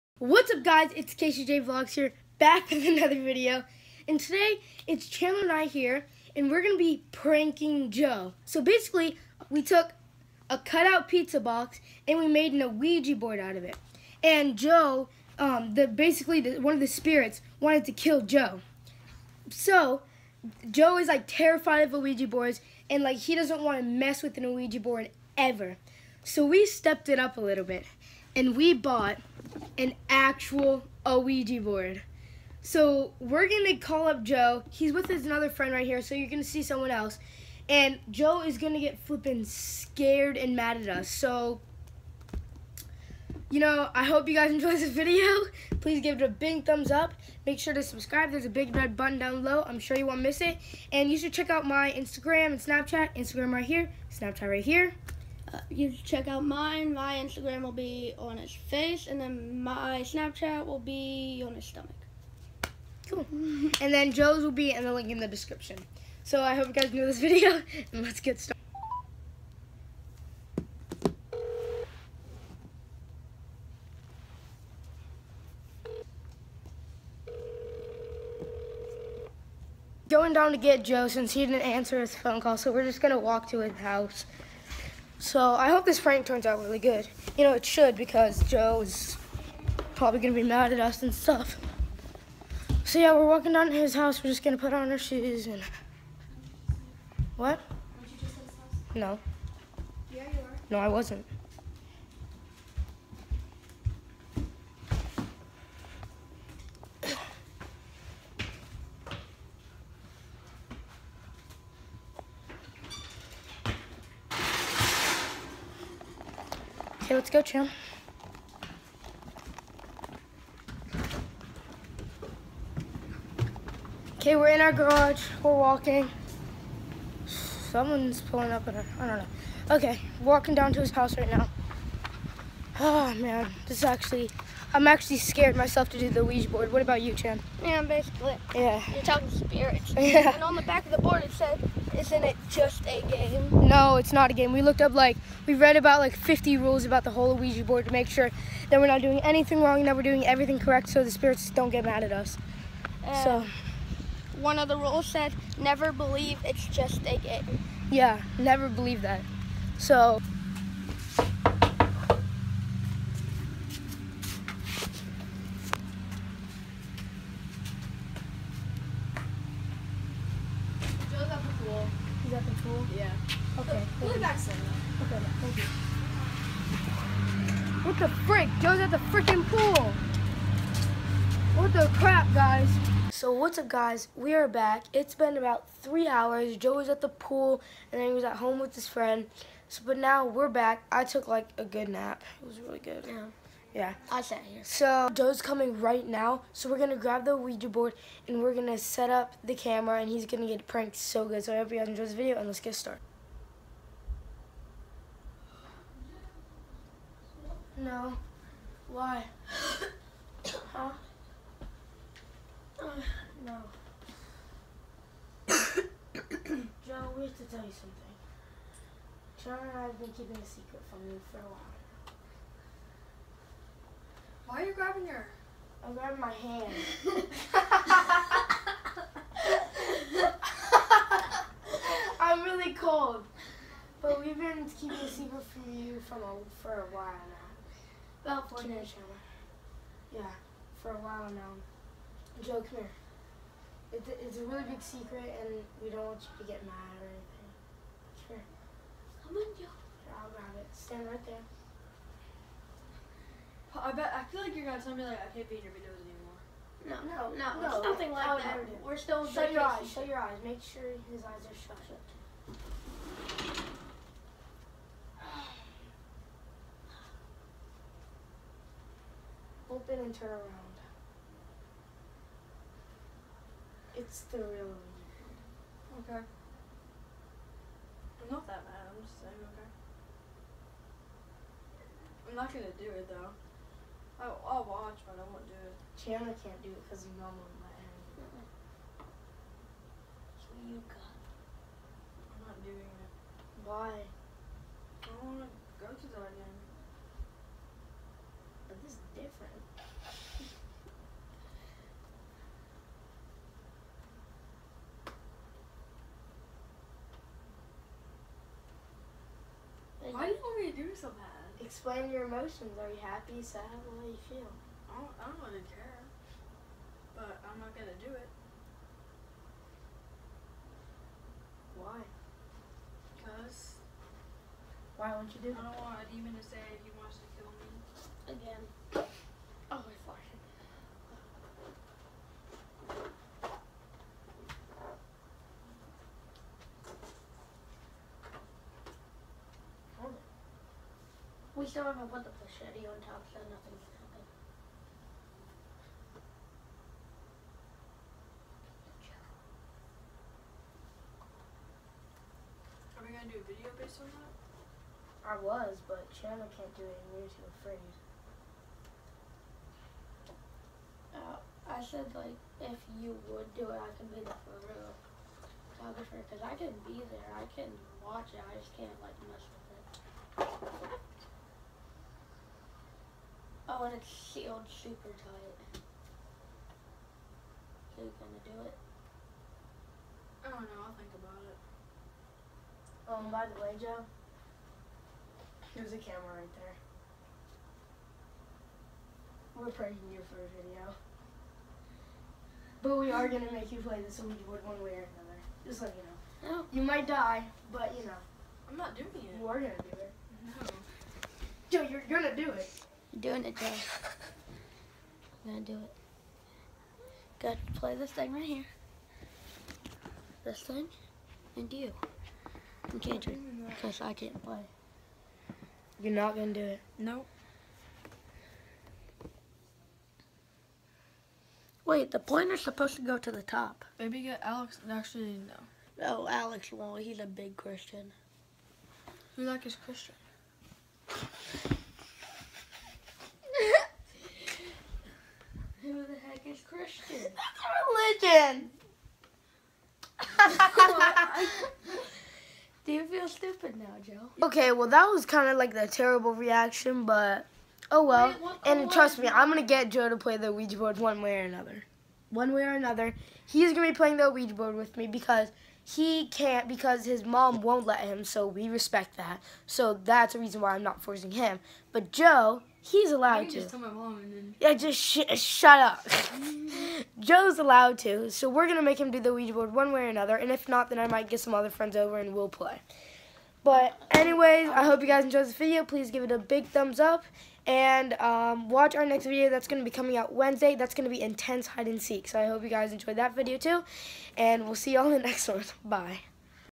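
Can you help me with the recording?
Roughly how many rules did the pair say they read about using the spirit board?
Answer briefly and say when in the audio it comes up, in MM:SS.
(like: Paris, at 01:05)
50, at 02:26.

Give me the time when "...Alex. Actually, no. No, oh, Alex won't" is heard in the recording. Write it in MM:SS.
07:04.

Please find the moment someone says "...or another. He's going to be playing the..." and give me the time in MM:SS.
07:32.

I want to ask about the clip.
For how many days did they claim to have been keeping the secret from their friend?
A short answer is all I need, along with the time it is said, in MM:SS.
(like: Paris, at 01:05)
four days, at 03:58.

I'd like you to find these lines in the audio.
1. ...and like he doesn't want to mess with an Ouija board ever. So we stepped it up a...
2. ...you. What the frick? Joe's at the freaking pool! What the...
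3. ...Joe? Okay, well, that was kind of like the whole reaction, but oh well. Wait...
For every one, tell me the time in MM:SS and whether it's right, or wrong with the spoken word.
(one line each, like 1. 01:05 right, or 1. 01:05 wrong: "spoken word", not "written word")
1. 00:22 right
2. 02:55 right
3. 07:24 wrong: "terrible", not "whole".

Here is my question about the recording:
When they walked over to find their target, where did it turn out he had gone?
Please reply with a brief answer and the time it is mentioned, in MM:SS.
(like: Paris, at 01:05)
the pool, at 03:07.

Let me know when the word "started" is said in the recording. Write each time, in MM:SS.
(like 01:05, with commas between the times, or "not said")
01:08, 03:22.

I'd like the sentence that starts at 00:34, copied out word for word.
He's with his another friend right here, so you're gonna see someone else.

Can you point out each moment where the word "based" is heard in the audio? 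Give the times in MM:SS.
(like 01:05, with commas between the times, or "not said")
05:53.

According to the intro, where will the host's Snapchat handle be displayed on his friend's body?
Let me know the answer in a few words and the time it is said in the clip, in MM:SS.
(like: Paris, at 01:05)
his stomach, at 01:01.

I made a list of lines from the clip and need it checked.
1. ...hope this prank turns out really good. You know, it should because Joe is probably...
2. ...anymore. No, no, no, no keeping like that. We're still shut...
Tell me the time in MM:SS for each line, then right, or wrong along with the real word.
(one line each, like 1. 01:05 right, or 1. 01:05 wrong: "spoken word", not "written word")
1. 01:25 right
2. 04:16 wrong: "nothing", not "keeping".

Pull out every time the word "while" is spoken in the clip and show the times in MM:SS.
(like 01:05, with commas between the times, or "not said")
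03:41, 03:56, 04:00.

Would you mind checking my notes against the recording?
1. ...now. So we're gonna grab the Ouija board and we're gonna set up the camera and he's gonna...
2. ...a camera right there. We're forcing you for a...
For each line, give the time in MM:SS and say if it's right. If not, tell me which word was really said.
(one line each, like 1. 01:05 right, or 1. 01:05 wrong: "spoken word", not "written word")
1. 03:16 right
2. 06:25 wrong: "praying", not "forcing".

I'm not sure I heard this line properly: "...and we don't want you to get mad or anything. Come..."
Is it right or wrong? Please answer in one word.
right.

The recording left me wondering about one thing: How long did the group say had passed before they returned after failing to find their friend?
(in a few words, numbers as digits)
three hours.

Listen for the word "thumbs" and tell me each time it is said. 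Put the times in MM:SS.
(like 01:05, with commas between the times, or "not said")
00:46, 07:56.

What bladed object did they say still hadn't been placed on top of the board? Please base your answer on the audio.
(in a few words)
machete.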